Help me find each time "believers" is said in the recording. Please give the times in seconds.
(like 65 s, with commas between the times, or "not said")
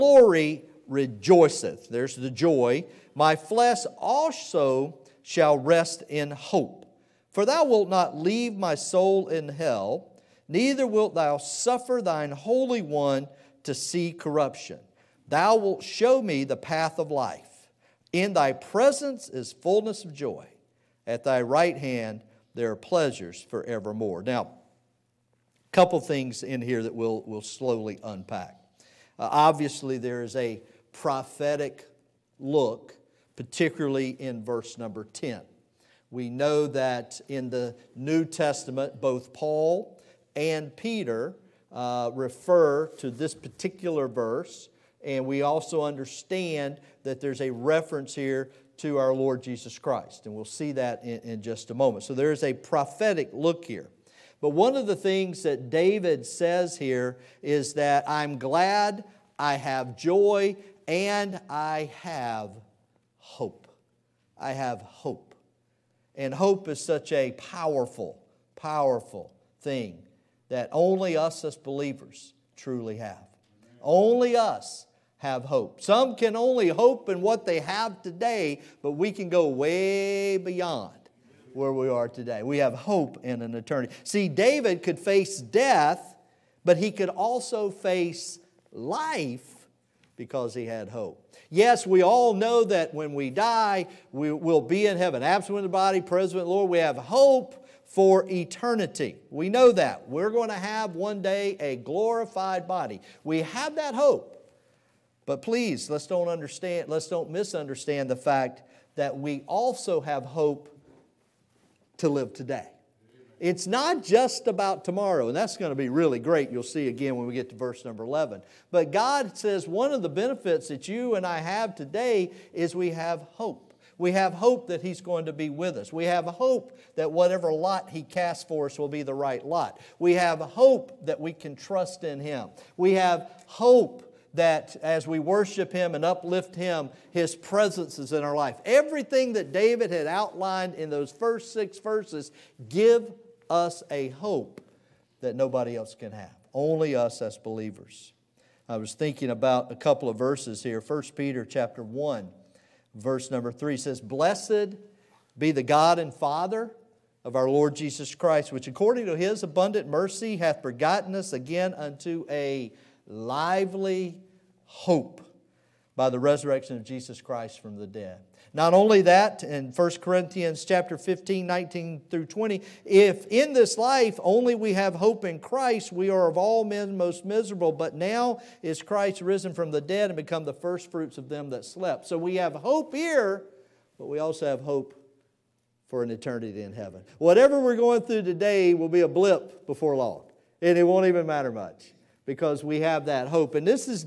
71 s, 147 s.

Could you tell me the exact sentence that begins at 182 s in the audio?
So we have hope here, but we also have hope for an eternity in heaven.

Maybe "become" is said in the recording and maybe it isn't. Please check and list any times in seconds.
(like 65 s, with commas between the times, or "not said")
180 s.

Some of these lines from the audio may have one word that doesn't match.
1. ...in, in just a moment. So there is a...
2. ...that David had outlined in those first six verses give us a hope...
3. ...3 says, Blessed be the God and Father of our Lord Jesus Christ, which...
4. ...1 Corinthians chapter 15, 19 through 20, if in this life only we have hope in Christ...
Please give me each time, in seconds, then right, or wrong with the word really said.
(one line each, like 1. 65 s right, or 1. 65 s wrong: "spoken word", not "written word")
1. 51 s right
2. 139 s right
3. 153 s right
4. 169 s right.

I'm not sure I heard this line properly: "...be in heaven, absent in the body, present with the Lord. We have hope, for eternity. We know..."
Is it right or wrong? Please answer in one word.
right.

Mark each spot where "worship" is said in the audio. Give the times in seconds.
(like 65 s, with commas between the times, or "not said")
135 s.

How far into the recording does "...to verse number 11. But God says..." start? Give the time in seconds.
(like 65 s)
117 s.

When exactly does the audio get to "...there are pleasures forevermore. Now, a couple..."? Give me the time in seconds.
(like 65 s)
22 s.